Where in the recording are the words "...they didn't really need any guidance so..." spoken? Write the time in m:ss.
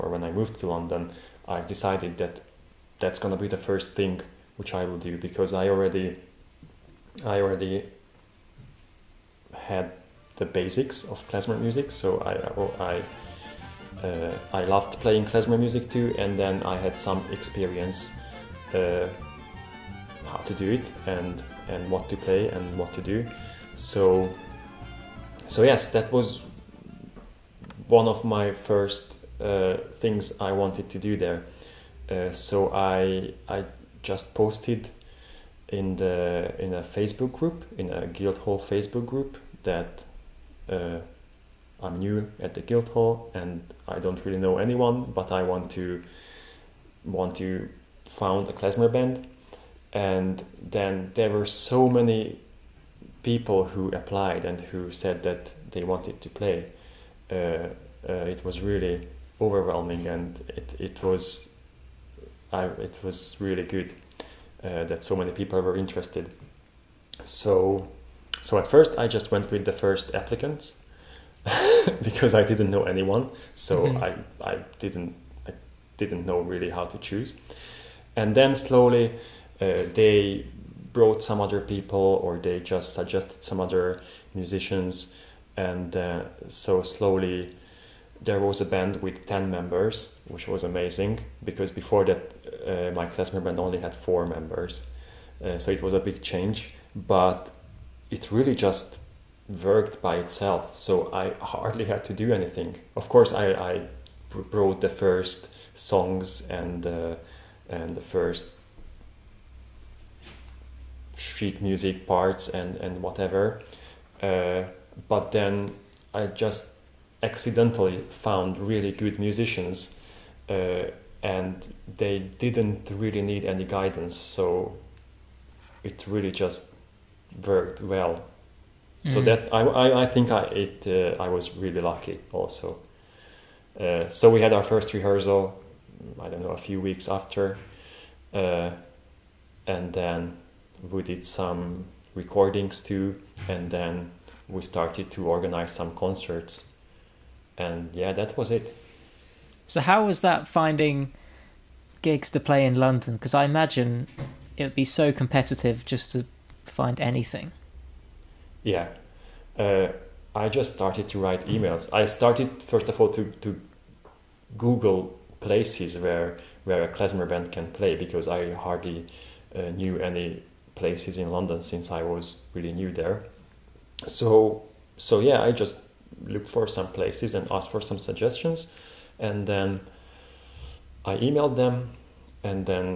2:01.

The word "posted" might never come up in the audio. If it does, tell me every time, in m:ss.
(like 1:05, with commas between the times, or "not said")
0:34.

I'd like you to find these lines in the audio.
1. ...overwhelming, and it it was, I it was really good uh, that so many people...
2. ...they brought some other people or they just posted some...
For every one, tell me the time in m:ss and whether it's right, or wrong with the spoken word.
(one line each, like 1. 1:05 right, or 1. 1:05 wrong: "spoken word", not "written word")
1. 0:59 right
2. 1:19 wrong: "suggested", not "posted".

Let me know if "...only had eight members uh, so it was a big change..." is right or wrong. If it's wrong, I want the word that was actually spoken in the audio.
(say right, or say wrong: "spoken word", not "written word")
wrong: "four", not "eight".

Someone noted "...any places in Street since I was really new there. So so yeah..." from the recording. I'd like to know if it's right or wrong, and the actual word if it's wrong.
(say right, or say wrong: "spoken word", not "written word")
wrong: "London", not "Street".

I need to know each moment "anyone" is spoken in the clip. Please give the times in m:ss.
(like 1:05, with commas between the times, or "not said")
0:44, 1:12.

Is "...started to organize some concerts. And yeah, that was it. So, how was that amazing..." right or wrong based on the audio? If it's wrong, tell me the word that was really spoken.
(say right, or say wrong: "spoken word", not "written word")
wrong: "finding", not "amazing".